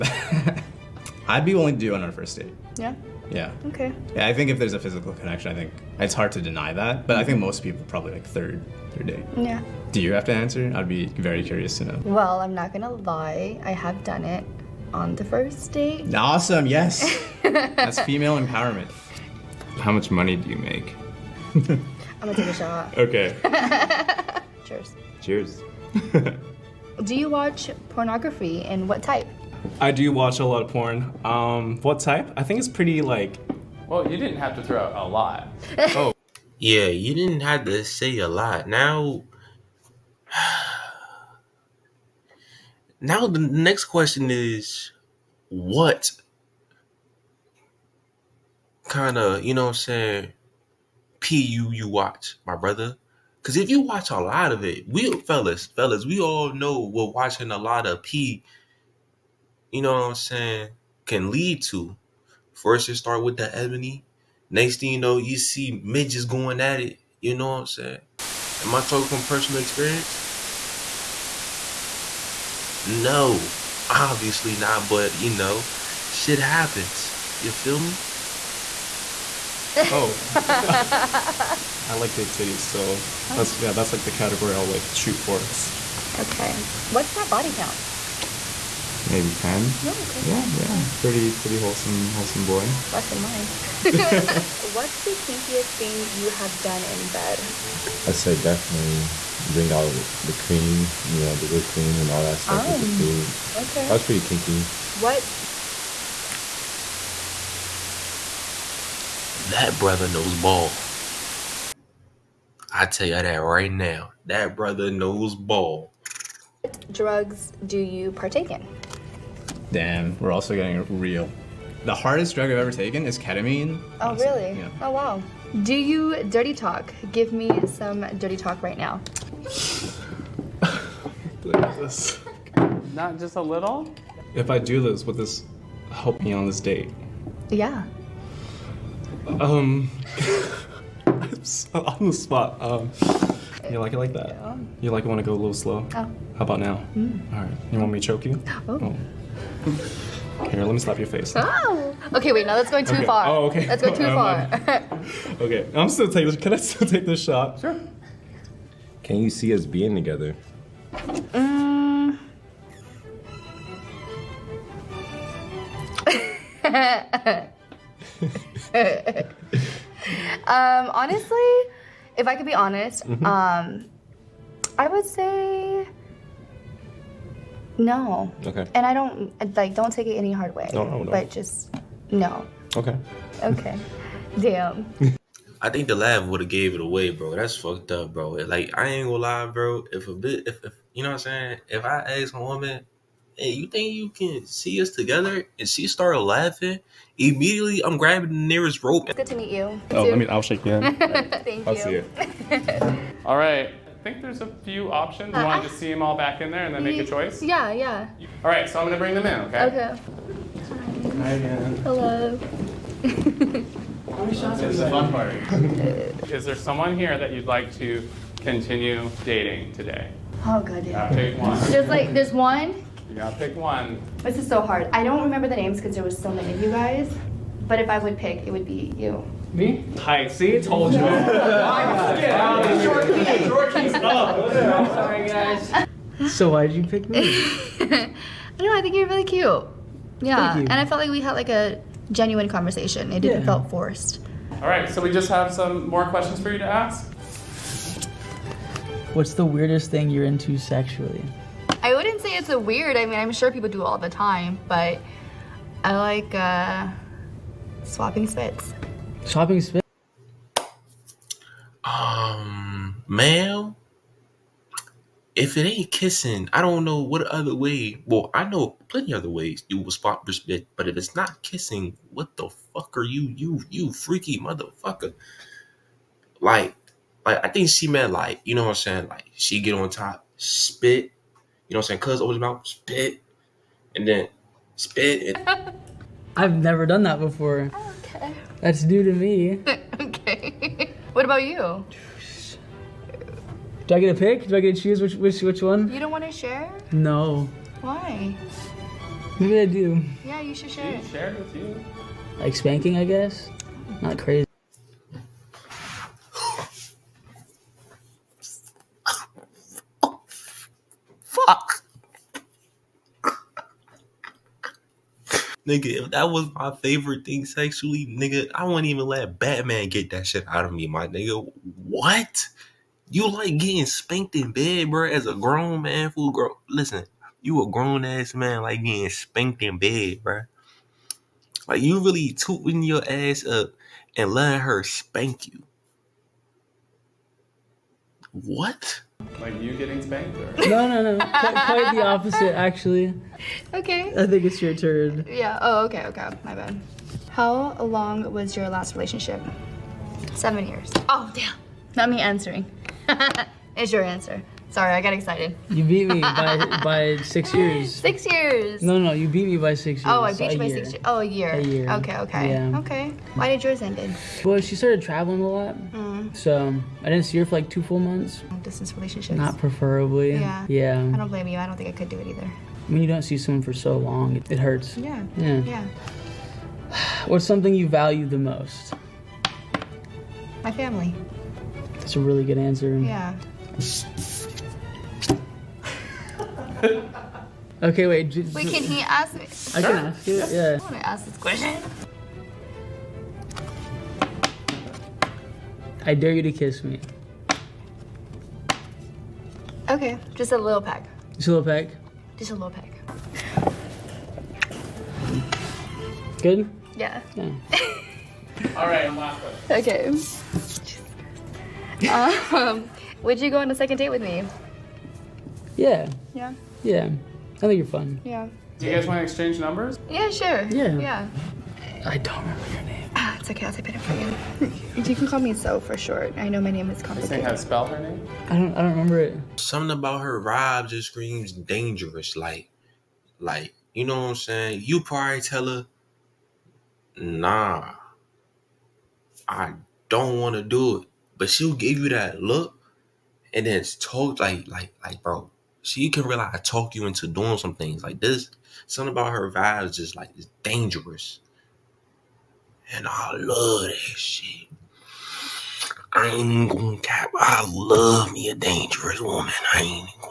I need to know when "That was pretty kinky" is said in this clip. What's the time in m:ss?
1:43.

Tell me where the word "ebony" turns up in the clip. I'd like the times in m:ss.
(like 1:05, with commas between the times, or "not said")
1:03.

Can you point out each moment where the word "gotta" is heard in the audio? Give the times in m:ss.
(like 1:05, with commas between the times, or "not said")
3:43.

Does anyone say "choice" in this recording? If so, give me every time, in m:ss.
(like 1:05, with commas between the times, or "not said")
3:27.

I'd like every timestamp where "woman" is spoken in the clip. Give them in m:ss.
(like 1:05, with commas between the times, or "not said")
3:12, 7:39.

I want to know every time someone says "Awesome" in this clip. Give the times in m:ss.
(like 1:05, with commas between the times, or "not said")
0:16.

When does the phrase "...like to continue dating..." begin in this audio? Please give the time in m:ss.
3:37.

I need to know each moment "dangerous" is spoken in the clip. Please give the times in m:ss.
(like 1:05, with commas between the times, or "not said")
7:11, 7:30, 7:38.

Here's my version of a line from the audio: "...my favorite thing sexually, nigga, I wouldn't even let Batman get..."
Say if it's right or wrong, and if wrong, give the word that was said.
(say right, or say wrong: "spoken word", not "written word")
right.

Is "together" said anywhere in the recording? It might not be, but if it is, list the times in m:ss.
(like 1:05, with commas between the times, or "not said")
2:39, 3:14.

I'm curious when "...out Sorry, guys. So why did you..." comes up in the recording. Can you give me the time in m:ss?
3:52.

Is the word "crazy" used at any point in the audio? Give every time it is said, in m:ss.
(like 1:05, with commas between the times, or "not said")
5:04.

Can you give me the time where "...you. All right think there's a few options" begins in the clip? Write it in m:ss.
3:21.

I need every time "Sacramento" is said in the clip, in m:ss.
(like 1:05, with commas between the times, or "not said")
not said.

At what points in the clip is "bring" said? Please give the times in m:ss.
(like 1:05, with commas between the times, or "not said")
1:39, 3:28.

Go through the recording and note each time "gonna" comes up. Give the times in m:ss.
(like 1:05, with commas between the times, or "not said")
0:12, 0:22, 3:09, 7:36.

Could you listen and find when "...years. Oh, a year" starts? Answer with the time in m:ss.
6:00.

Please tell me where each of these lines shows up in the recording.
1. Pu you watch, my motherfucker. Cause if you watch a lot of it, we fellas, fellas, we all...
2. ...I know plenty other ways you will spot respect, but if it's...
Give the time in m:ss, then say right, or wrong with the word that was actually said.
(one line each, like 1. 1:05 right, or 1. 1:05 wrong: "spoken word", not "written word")
1. 0:51 wrong: "brother", not "motherfucker"
2. 4:28 right.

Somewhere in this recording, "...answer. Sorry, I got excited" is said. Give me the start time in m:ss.
5:54.